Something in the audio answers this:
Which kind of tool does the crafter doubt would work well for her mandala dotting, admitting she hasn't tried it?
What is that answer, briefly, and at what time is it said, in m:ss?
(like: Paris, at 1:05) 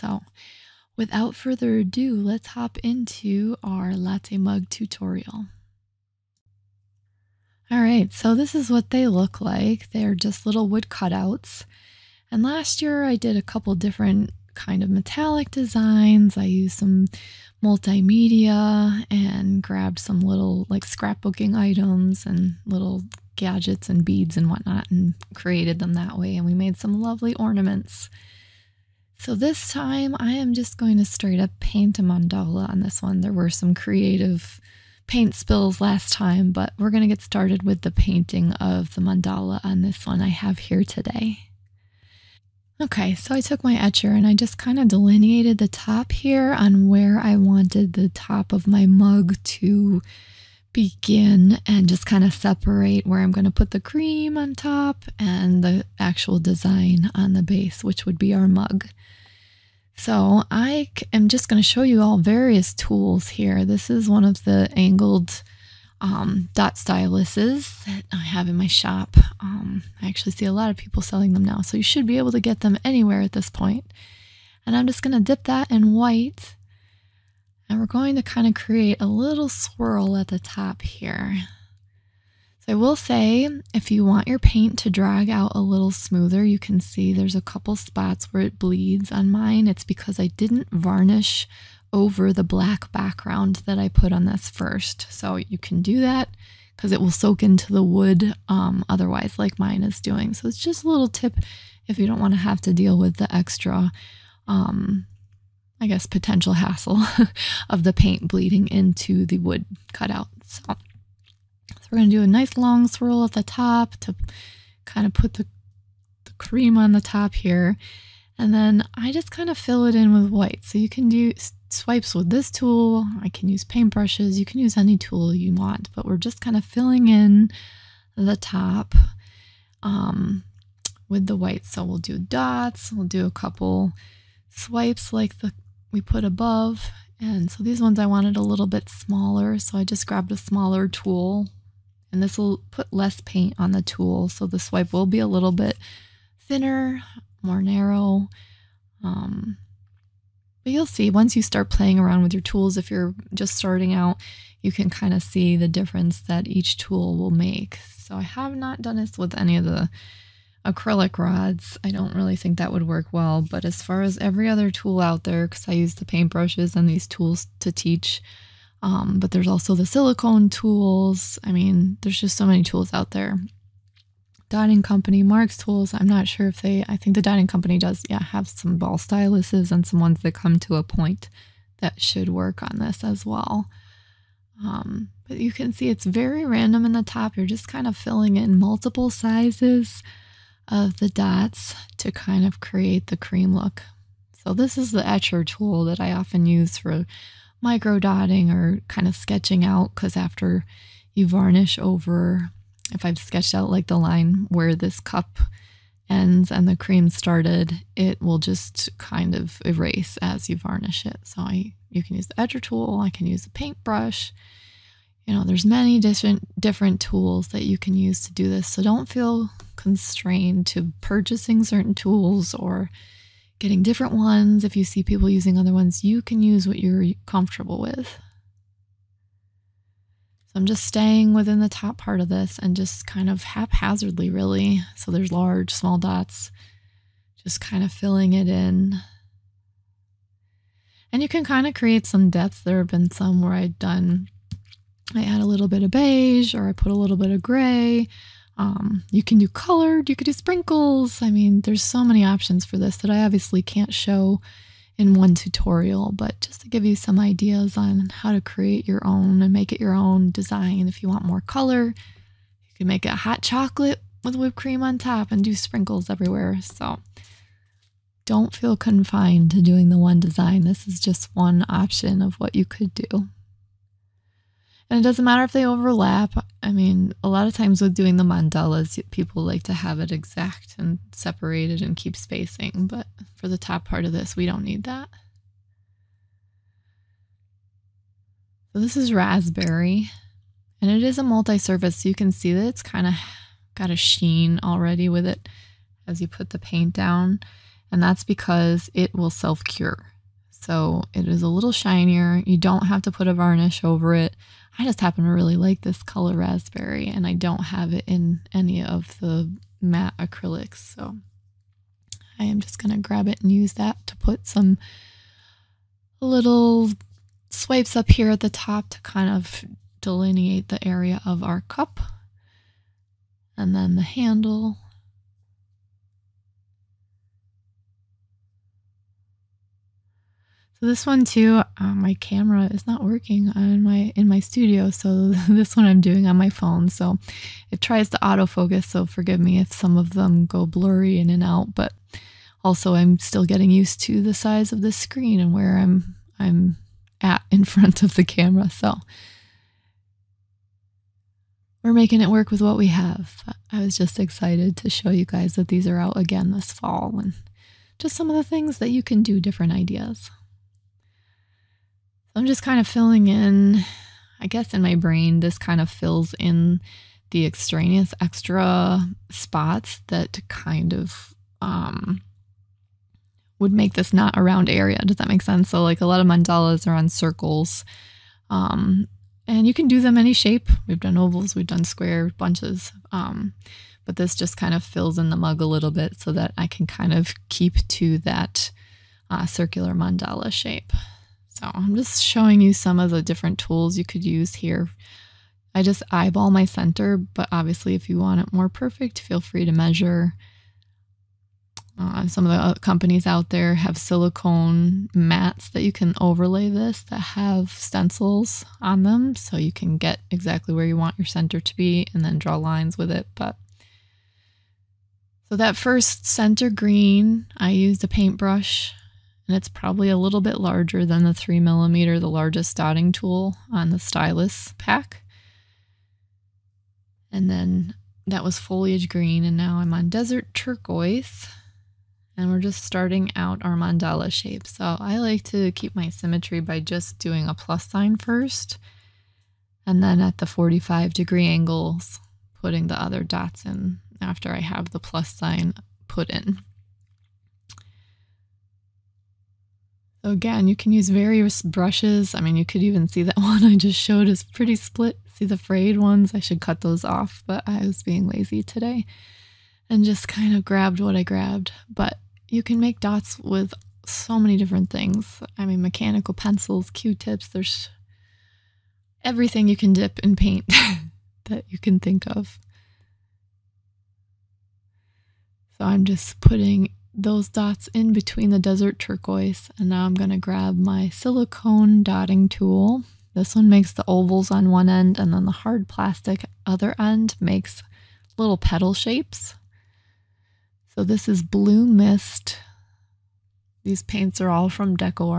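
Acrylic rods, at 2:40.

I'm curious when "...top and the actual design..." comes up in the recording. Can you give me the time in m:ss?
0:54.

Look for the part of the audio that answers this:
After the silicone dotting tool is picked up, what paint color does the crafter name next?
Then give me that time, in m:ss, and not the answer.
8:11.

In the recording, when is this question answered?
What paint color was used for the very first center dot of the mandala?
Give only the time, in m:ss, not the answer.
7:08.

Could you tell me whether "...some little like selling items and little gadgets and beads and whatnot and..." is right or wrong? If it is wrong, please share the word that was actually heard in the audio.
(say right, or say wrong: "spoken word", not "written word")
wrong: "scrapbooking", not "selling".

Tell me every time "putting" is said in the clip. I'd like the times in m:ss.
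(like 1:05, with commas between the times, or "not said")
7:22, 7:56.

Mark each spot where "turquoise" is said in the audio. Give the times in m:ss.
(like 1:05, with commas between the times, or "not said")
7:10, 7:58.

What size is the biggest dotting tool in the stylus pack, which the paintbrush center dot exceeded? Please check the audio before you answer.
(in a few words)
3 millimeters.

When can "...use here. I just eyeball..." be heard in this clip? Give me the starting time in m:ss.
6:34.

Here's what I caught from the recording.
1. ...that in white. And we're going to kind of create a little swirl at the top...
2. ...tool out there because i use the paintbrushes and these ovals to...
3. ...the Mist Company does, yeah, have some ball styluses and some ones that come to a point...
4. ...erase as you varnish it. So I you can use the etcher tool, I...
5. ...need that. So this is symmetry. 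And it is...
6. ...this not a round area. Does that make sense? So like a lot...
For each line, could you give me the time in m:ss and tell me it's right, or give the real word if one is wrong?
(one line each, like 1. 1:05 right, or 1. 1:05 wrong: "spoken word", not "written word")
1. 1:15 right
2. 2:44 wrong: "tools", not "ovals"
3. 2:57 wrong: "Dining", not "Mist"
4. 3:29 right
5. 4:44 wrong: "raspberry", not "symmetry"
6. 6:13 right.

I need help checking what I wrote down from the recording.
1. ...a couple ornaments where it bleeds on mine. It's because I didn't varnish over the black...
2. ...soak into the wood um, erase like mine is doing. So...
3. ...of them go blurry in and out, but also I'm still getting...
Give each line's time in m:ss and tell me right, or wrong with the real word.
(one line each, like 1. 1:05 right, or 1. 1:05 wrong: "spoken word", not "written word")
1. 1:27 wrong: "spots", not "ornaments"
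2. 1:37 wrong: "otherwise", not "erase"
3. 5:39 right.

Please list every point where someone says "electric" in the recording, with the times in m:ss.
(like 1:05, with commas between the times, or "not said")
not said.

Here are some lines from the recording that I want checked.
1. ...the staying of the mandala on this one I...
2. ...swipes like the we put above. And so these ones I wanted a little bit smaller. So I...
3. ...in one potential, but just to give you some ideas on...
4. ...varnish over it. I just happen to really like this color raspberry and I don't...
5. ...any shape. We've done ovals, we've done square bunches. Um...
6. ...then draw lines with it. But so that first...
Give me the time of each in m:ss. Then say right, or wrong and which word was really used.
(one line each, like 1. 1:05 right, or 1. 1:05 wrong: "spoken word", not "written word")
1. 0:37 wrong: "painting", not "staying"
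2. 2:14 right
3. 4:14 wrong: "tutorial", not "potential"
4. 5:03 right
5. 6:20 right
6. 6:52 right.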